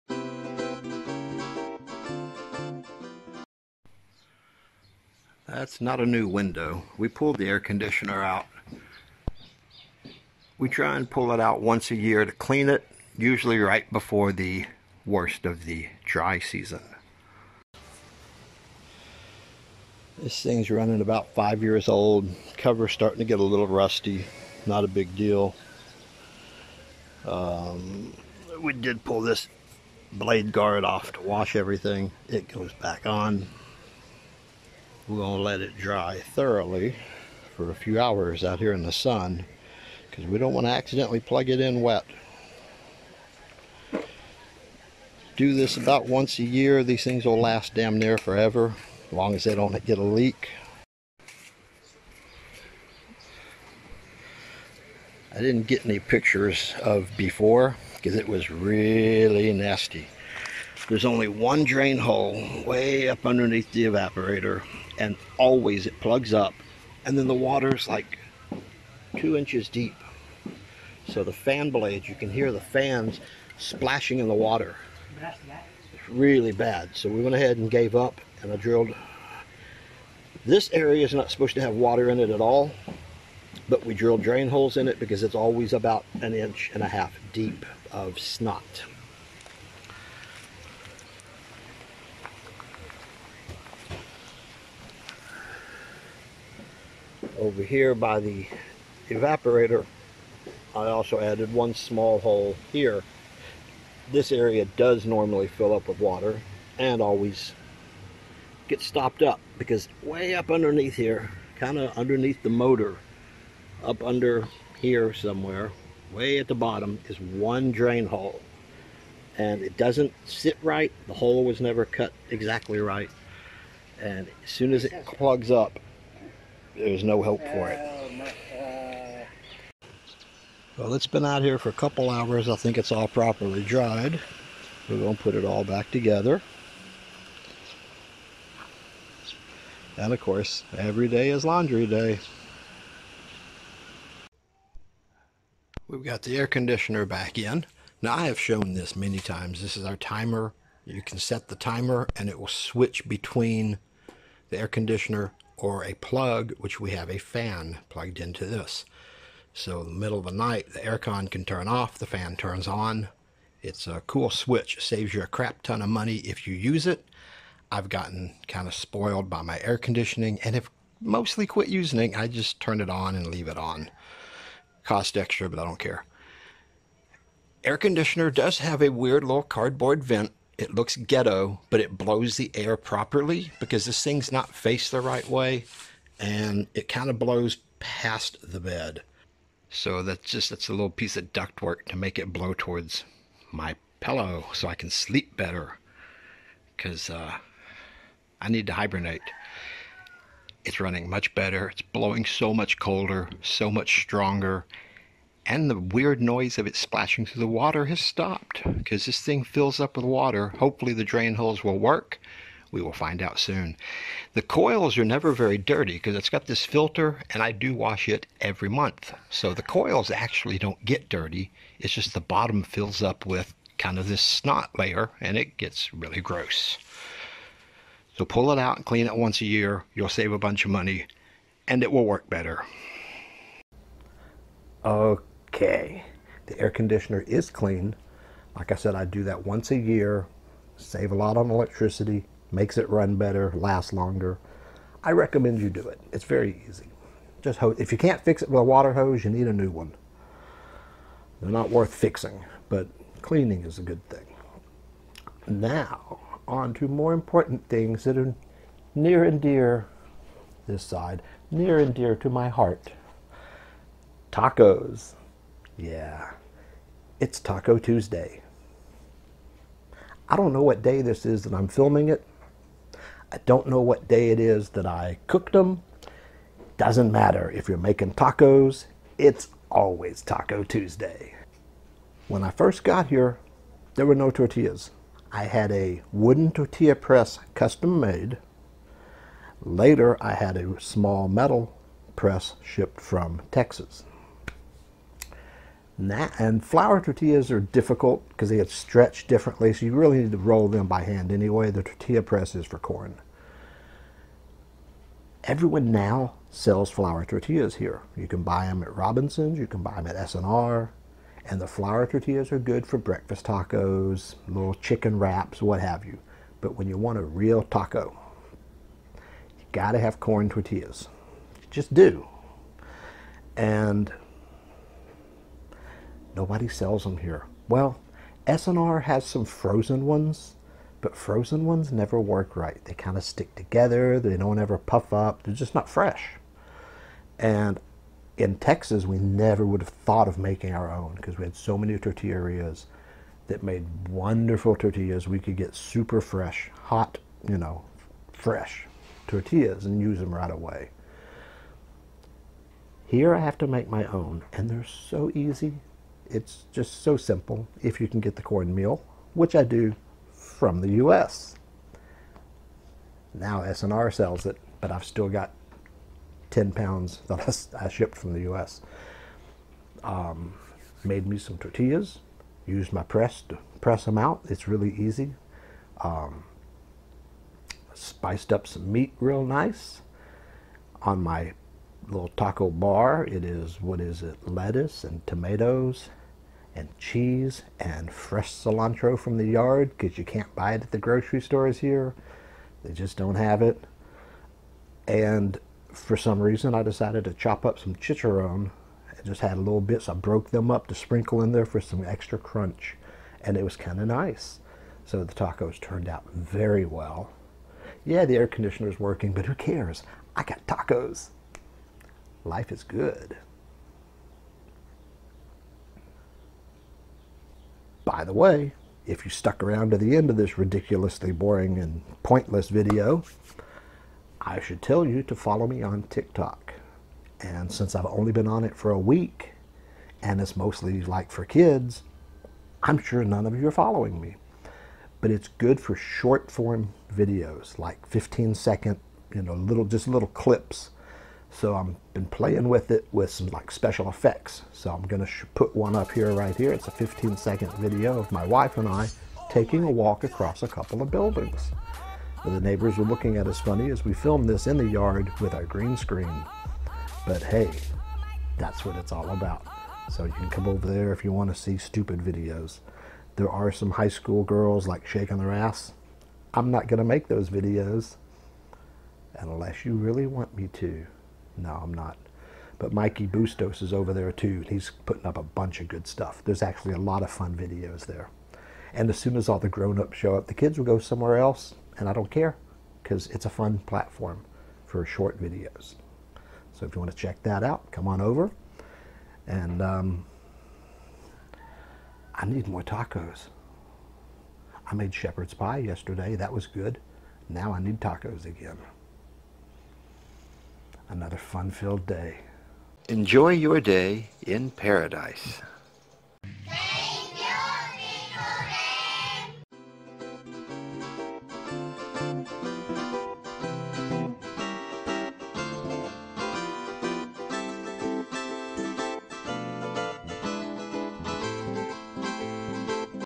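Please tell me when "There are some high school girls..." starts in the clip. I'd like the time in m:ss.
7:43.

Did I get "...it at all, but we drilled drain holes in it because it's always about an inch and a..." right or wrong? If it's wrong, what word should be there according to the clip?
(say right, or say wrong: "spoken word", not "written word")
right.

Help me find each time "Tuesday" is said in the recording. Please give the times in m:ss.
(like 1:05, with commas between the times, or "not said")
4:27, 4:40.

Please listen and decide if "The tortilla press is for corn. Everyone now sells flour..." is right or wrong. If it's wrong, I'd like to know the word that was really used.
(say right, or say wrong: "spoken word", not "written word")
right.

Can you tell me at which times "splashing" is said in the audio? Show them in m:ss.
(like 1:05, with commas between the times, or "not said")
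1:13, 3:26.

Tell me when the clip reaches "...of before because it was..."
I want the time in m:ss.
0:56.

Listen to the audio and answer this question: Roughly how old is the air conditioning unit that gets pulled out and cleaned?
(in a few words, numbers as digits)
5 years.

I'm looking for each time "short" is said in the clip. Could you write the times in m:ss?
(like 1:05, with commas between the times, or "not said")
7:15, 8:05.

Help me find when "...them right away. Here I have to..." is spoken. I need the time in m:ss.
5:50.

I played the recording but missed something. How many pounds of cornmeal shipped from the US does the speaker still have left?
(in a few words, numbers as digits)
10.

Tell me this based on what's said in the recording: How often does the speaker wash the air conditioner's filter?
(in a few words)
every month.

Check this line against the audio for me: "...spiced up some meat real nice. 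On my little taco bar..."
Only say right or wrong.
right.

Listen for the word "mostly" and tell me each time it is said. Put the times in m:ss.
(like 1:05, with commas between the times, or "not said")
2:50, 7:10.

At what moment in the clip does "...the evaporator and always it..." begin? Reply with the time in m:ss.
1:03.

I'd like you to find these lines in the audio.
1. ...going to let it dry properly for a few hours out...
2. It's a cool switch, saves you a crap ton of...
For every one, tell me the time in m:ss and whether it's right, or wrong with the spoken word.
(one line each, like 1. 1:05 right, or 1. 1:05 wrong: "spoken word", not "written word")
1. 0:35 wrong: "thoroughly", not "properly"
2. 2:43 right.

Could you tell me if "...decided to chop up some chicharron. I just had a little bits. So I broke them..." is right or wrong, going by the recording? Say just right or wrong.
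right.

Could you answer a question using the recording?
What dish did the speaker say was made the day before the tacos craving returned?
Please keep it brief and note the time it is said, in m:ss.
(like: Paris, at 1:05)
shepherd's pie, at 8:15.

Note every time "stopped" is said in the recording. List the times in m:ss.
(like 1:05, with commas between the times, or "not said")
1:48, 3:27.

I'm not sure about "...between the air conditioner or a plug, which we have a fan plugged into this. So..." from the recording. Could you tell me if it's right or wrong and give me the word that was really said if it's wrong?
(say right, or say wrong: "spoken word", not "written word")
right.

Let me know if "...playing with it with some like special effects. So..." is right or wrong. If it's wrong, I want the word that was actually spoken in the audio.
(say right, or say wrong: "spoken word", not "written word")
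right.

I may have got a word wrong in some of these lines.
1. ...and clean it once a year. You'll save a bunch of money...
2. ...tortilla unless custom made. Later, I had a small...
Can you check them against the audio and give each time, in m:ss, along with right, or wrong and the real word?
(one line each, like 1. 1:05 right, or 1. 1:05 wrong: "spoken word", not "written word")
1. 3:48 right
2. 4:46 wrong: "press", not "unless".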